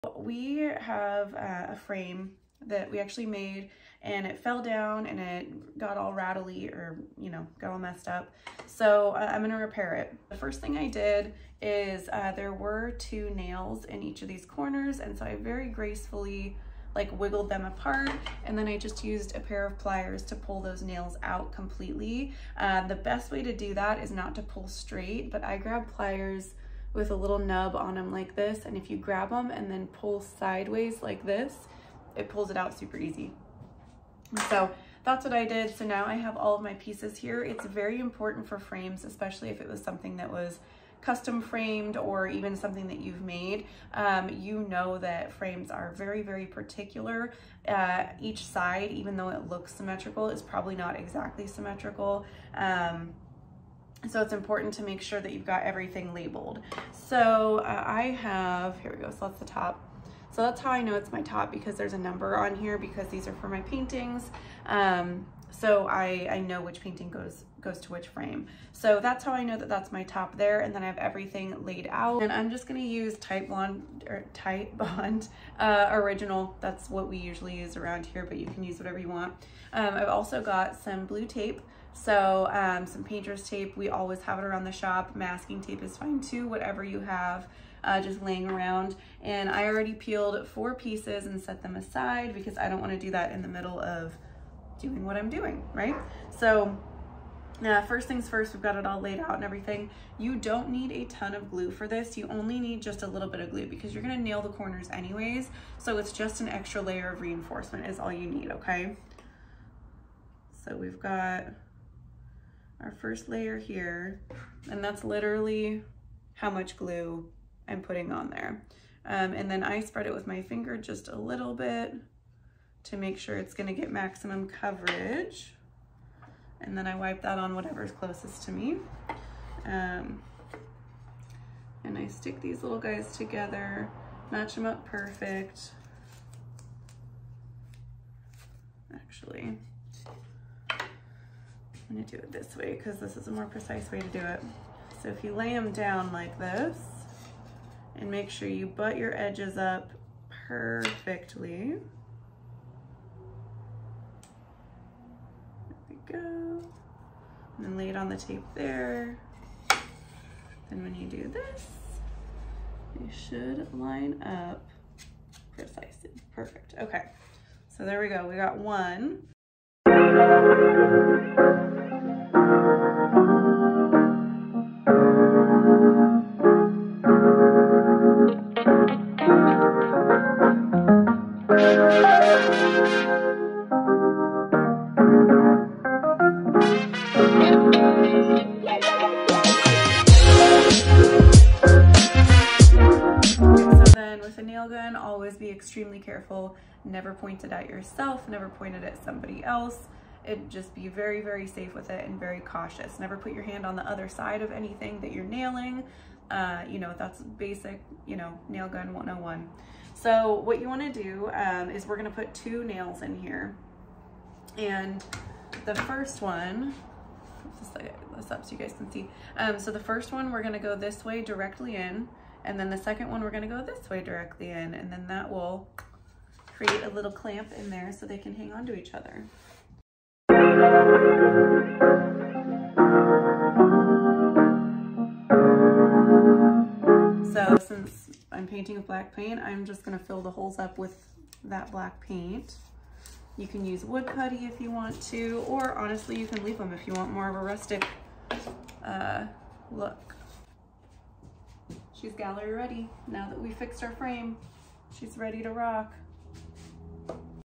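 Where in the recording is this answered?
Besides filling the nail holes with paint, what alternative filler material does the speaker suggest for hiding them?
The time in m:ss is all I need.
4:03.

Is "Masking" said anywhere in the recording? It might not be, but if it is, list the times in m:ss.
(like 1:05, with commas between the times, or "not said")
1:25.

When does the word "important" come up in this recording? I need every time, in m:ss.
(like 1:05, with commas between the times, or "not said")
0:37, 0:54.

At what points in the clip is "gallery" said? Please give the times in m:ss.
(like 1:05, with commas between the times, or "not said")
4:12.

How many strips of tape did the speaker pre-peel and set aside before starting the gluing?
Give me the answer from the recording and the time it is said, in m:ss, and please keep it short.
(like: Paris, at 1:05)
4, at 1:30.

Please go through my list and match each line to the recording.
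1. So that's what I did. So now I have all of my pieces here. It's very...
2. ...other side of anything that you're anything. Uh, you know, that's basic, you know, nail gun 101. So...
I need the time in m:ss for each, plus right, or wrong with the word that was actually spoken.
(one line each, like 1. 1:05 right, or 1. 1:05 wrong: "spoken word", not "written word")
1. 0:34 right
2. 3:23 wrong: "nailing", not "anything".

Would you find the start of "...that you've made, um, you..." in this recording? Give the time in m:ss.
0:42.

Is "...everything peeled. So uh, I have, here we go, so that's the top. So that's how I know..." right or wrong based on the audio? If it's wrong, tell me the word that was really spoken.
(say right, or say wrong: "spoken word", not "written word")
wrong: "labeled", not "peeled".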